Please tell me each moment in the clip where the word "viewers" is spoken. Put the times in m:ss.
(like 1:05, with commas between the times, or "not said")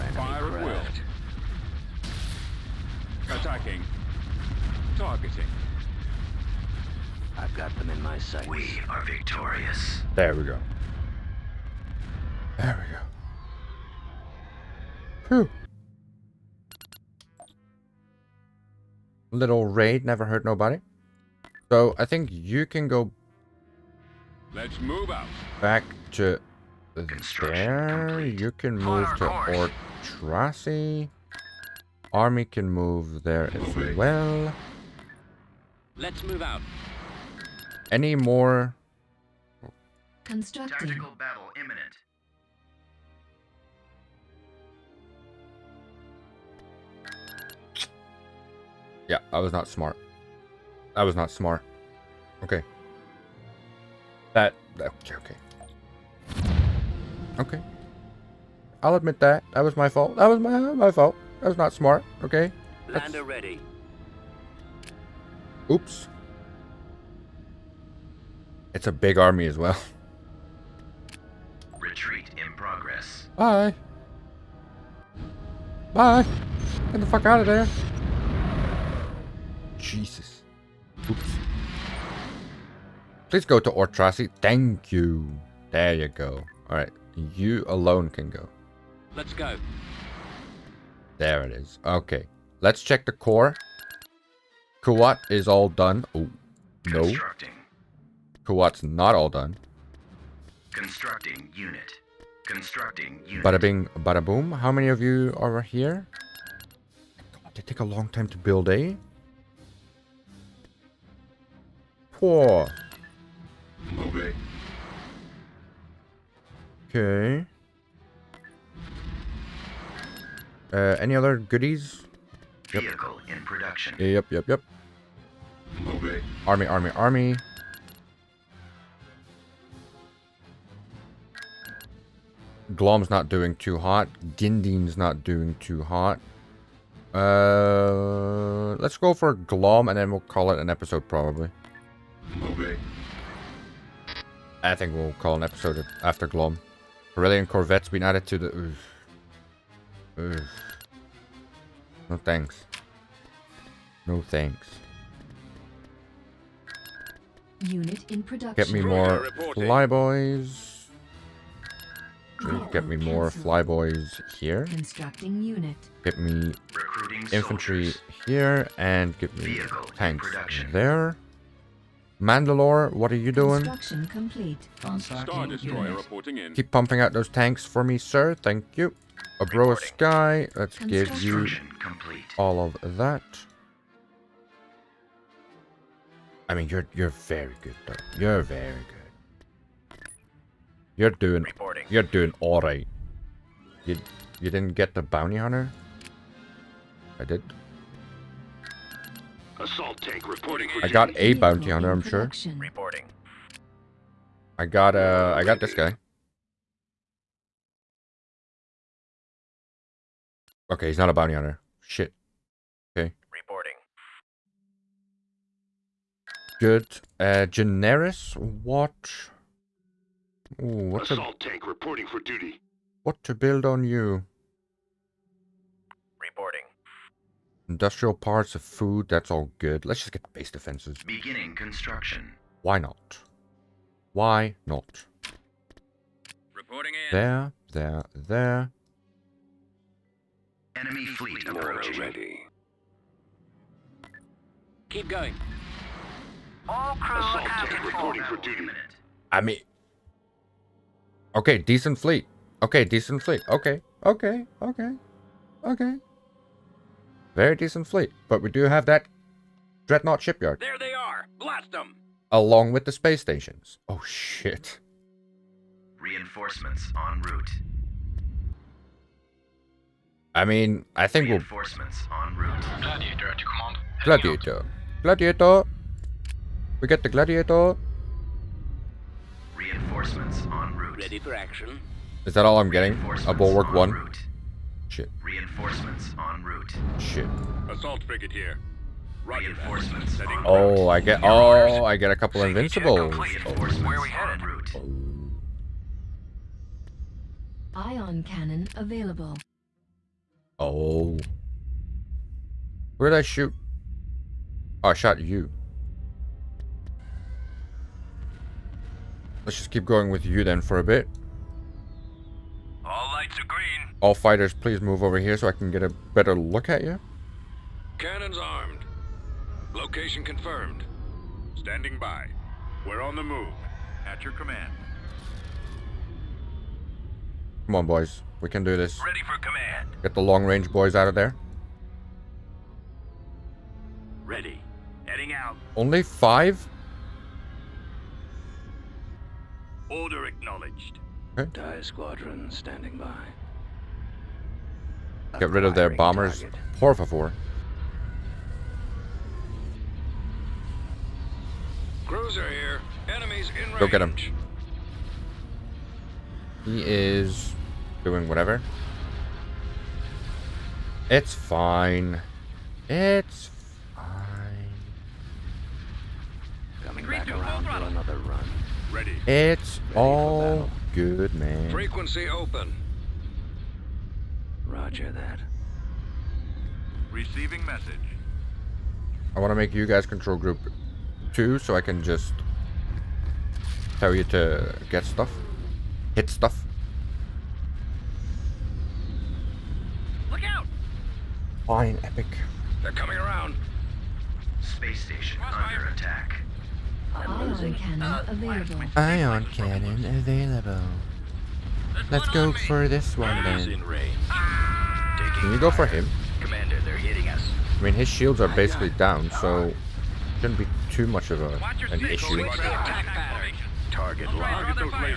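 not said.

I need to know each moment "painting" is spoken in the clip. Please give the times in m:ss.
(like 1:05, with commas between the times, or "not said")
not said.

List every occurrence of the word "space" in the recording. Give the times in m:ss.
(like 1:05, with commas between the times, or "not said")
4:22, 6:34.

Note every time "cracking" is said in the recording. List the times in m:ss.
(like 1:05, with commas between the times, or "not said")
not said.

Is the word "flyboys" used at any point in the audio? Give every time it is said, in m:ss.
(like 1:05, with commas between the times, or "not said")
2:43.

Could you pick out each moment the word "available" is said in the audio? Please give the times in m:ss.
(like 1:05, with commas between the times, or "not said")
4:58, 6:40.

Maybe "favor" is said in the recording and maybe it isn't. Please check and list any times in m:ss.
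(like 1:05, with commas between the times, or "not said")
5:47.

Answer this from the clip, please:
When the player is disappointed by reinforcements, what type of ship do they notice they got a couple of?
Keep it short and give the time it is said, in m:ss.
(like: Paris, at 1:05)
Invincibles, at 4:52.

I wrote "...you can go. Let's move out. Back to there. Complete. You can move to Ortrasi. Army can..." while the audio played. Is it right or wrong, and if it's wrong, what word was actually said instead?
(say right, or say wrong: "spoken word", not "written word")
right.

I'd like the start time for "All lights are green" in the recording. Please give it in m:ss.
5:12.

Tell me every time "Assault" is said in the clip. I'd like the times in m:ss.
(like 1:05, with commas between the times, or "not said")
3:19, 3:41, 4:07, 4:47.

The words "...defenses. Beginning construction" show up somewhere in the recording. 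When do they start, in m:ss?
3:50.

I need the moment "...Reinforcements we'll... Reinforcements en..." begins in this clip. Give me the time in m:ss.
4:31.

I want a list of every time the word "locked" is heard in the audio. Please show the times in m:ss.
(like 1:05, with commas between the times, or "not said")
6:54.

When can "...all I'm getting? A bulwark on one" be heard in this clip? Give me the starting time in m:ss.
4:42.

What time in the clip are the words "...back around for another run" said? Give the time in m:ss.
6:07.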